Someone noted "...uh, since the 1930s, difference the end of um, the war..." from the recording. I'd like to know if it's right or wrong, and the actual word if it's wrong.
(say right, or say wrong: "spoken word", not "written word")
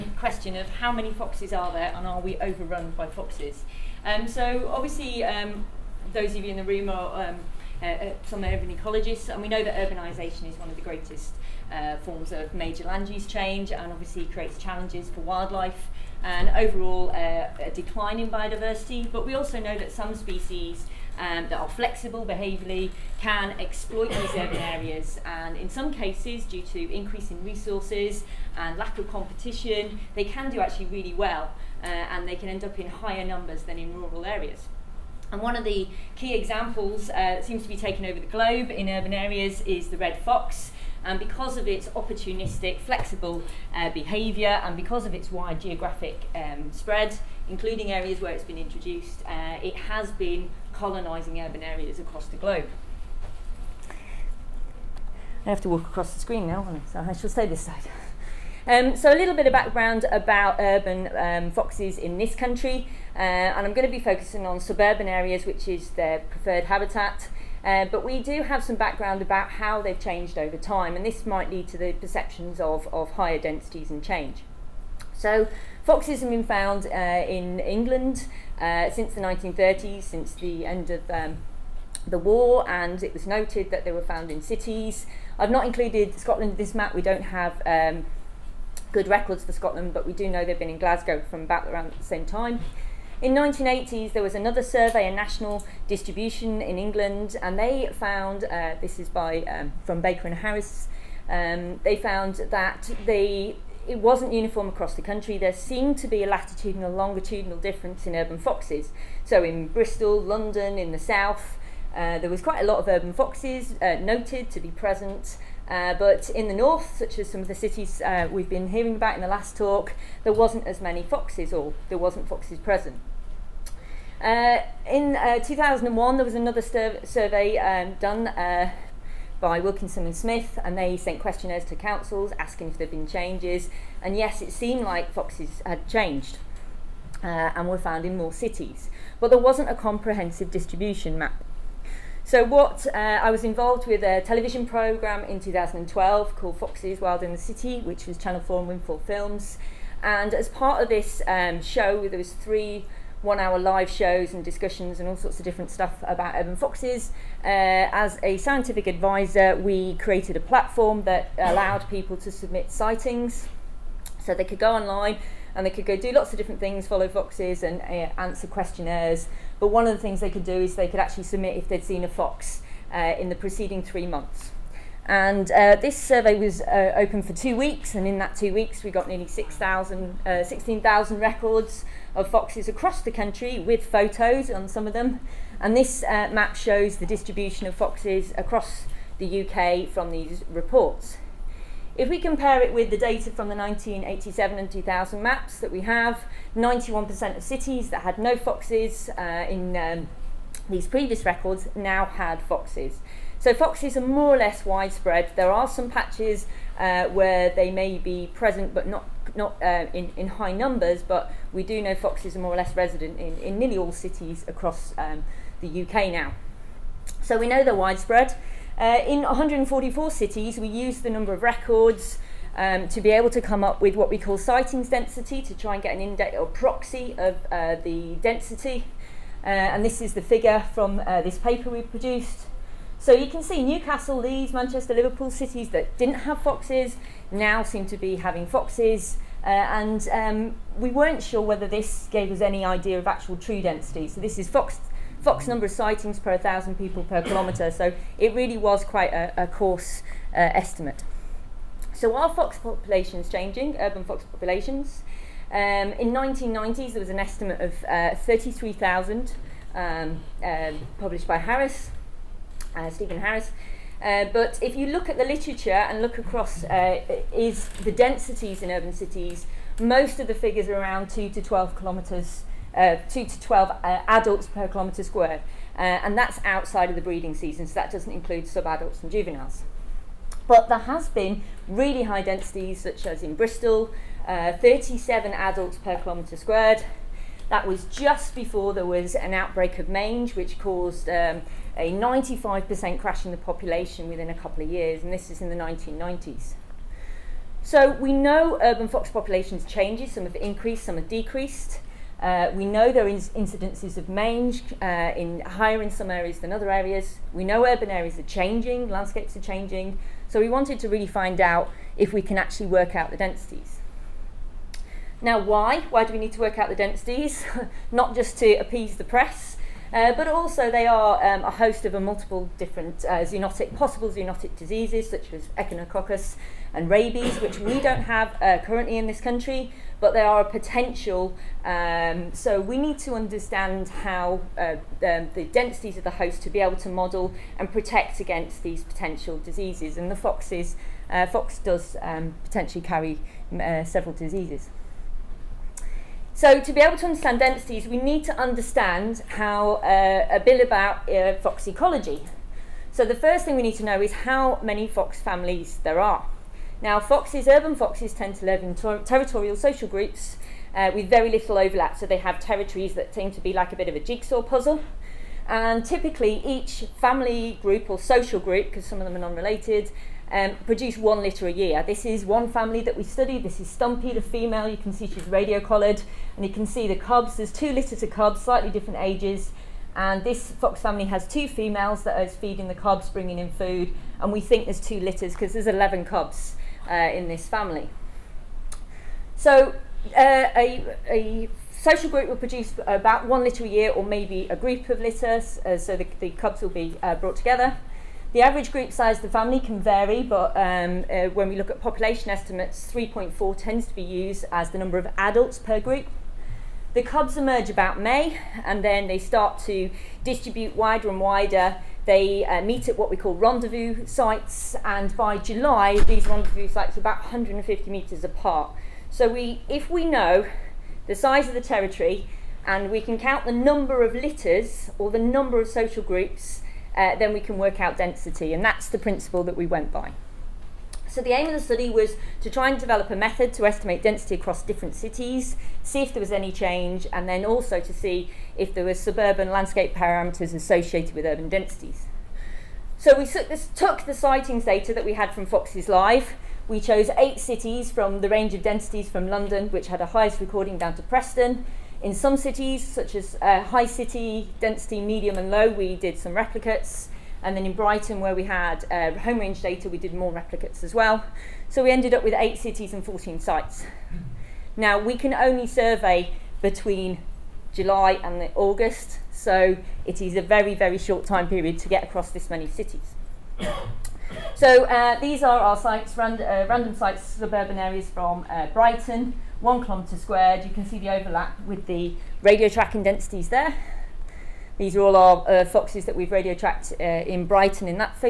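wrong: "since", not "difference".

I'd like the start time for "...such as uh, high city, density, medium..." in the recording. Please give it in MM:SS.
07:32.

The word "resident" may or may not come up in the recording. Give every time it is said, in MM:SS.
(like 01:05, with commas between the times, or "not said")
03:32.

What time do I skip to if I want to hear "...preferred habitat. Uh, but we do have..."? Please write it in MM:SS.
01:06.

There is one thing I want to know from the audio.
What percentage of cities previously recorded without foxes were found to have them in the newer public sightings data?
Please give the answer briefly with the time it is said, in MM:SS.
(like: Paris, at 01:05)
91%, at 03:16.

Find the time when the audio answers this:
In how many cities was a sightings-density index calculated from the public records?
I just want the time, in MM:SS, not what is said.
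03:39.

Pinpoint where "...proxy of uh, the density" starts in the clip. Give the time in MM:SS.
03:46.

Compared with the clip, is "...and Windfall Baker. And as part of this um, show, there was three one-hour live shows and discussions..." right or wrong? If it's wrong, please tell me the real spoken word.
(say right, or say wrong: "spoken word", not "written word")
wrong: "Films", not "Baker".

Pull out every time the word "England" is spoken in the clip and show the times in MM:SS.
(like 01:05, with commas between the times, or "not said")
01:17, 01:36.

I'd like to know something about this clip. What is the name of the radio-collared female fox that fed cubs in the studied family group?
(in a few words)
Stumpy.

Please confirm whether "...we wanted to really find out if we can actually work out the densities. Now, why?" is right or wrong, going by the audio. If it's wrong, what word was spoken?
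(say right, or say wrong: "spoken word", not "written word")
right.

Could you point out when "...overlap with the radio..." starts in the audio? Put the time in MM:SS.
08:01.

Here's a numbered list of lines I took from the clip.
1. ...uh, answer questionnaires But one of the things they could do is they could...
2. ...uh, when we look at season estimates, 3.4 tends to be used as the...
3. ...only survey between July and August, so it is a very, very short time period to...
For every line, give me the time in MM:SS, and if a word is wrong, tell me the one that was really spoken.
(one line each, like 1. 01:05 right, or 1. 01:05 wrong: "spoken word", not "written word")
1. 02:47 right
2. 06:41 wrong: "population", not "season"
3. 07:45 right.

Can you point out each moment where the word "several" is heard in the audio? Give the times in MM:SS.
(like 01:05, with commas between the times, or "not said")
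05:43.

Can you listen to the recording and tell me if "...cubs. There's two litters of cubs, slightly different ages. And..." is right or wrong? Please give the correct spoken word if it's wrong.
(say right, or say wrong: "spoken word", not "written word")
right.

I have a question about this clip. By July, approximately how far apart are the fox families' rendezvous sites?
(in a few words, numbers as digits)
150 metres.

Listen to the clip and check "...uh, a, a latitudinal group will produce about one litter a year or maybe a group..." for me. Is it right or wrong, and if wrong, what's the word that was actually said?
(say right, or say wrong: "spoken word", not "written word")
wrong: "social", not "latitudinal".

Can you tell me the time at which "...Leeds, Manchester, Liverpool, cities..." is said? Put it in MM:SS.
03:54.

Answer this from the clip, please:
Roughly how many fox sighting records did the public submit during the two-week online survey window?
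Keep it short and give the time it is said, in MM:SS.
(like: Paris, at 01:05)
16,000, at 03:00.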